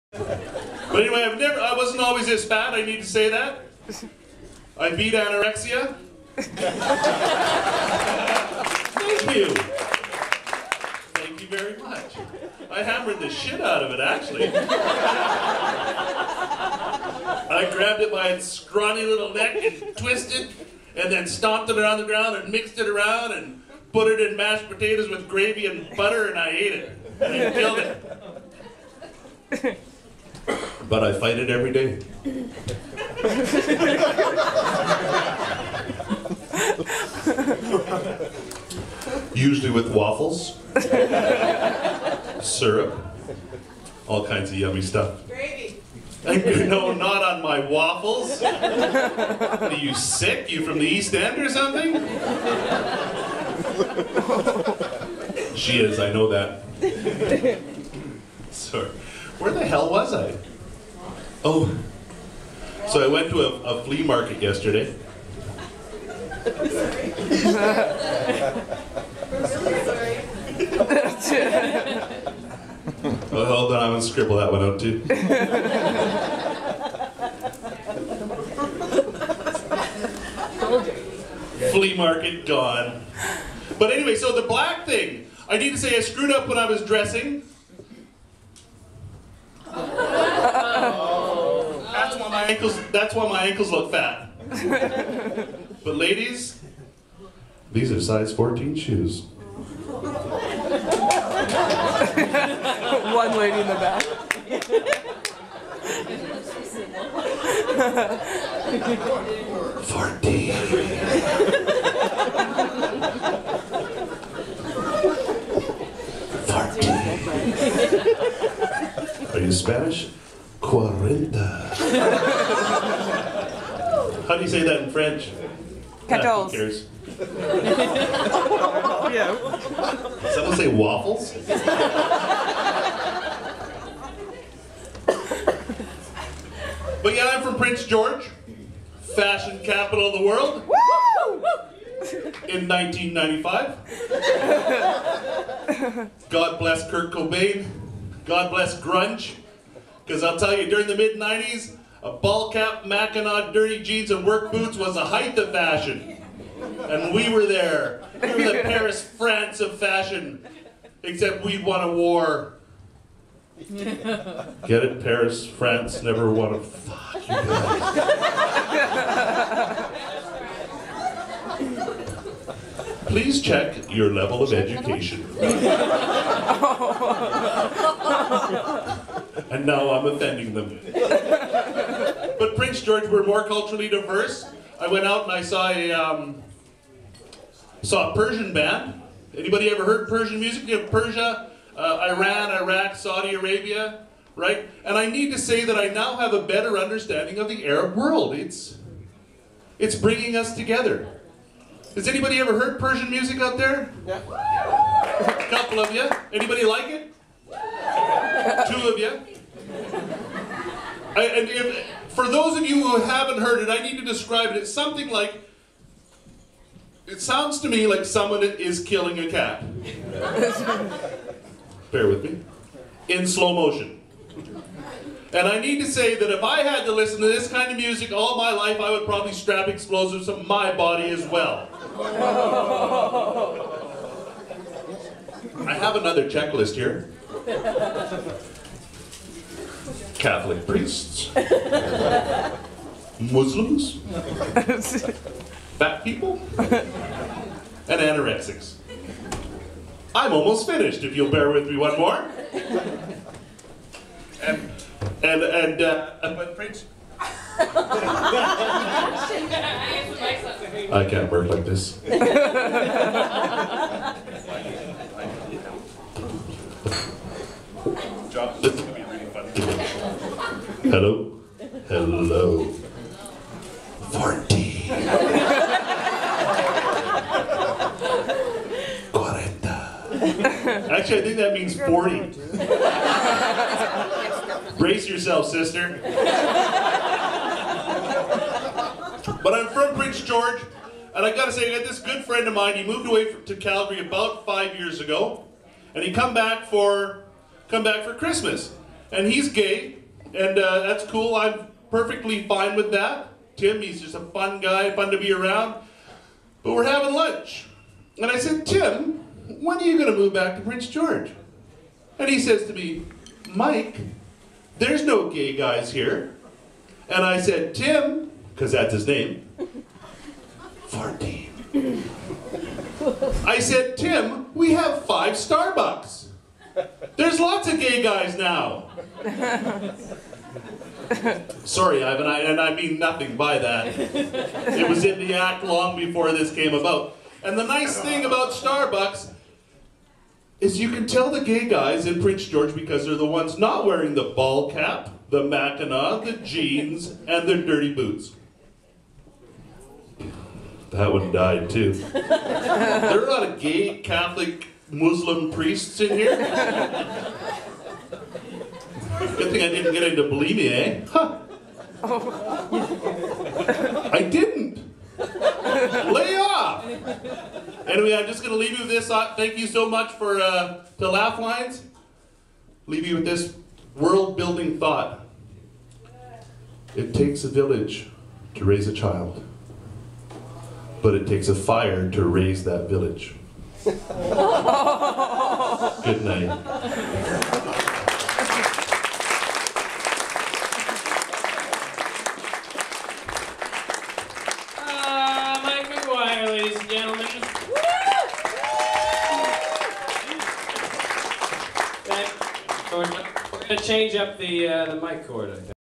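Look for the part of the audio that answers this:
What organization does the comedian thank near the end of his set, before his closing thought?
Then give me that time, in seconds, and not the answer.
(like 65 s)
371 s.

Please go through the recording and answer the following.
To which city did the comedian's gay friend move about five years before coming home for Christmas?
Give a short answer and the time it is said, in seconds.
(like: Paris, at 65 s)
Calgary, at 293 s.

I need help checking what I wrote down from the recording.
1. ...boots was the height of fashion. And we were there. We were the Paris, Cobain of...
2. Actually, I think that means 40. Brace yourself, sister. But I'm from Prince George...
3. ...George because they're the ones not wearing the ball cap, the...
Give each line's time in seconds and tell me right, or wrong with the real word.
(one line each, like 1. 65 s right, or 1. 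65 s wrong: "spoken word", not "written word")
1. 154 s wrong: "France", not "Cobain"
2. 280 s right
3. 342 s right.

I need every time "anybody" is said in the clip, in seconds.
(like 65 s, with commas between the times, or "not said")
189 s, 202 s, 206 s.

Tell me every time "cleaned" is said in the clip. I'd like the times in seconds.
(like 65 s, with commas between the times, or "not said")
not said.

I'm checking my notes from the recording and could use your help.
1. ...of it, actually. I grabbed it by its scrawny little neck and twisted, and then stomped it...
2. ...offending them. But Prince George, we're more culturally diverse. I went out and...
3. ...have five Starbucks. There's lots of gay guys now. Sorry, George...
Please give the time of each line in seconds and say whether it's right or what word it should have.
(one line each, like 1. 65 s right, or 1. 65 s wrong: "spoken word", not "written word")
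1. 13 s right
2. 180 s right
3. 324 s wrong: "Ivan", not "George".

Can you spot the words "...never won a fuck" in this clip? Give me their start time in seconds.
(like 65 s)
166 s.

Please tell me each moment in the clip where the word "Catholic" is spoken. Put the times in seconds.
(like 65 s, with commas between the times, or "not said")
240 s, 353 s.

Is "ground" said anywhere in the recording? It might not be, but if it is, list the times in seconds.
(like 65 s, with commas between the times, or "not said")
22 s.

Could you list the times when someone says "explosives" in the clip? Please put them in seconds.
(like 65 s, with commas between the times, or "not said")
229 s.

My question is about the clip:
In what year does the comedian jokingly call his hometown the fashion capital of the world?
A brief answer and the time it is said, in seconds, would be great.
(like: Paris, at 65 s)
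1995, at 142 s.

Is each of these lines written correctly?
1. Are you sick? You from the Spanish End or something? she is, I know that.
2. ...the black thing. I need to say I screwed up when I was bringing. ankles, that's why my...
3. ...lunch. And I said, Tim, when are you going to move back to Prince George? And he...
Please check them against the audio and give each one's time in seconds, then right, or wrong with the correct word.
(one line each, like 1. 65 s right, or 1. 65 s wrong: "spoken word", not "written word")
1. 48 s wrong: "East", not "Spanish"
2. 84 s wrong: "dressing", not "bringing"
3. 307 s right.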